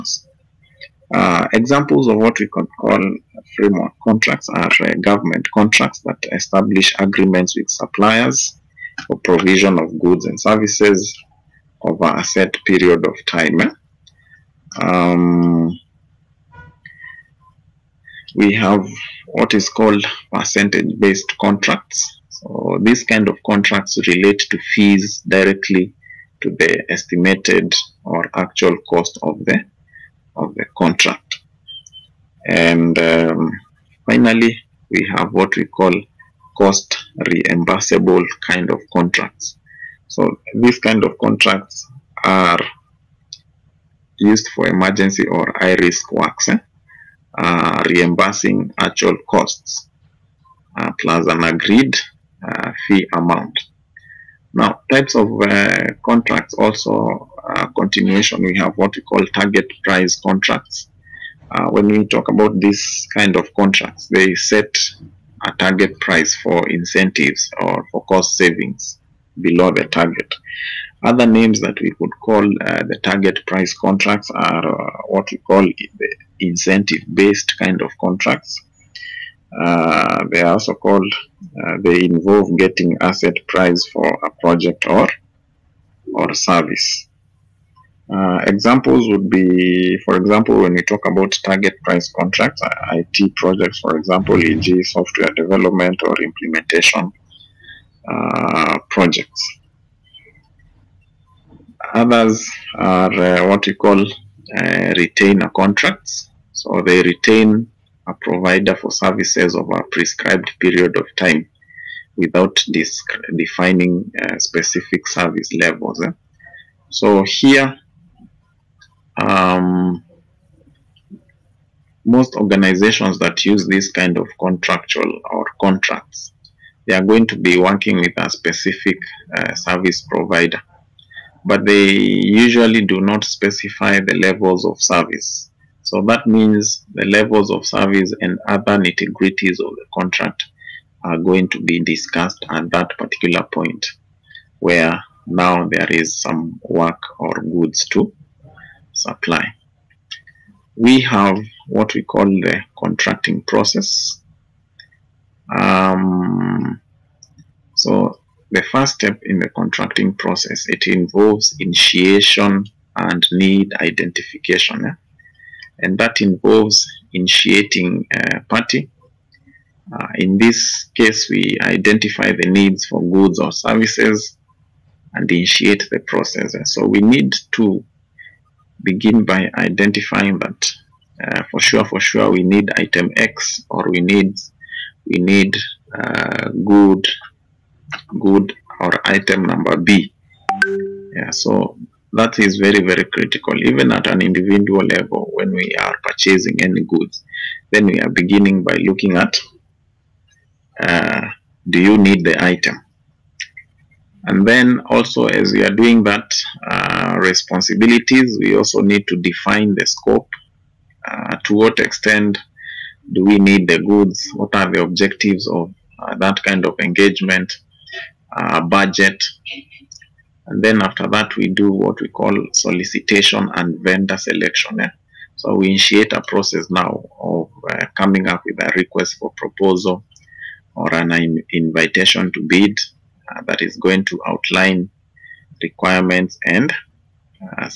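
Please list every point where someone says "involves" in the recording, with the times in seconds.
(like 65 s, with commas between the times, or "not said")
82 s, 160 s, 166 s.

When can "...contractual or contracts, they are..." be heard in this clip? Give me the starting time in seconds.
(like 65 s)
124 s.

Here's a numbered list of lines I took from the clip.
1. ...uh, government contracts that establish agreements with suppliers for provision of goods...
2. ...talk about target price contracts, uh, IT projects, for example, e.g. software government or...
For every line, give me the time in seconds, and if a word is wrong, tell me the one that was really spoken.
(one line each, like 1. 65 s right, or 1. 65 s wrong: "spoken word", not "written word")
1. 4 s right
2. 90 s wrong: "development", not "government".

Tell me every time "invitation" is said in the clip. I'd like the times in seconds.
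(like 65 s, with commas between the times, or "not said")
231 s.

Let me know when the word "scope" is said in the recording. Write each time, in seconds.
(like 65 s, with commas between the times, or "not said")
209 s.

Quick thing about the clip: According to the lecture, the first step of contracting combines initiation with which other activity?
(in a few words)
Need identification.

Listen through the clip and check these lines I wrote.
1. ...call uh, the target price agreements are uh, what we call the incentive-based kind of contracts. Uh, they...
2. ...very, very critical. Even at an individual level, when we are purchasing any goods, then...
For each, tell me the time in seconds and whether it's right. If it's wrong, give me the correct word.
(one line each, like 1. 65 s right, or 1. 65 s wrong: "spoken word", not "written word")
1. 72 s wrong: "contracts", not "agreements"
2. 192 s right.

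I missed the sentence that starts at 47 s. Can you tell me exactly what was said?
uh, reimbursing actual costs uh, plus an agreed uh, fee amount.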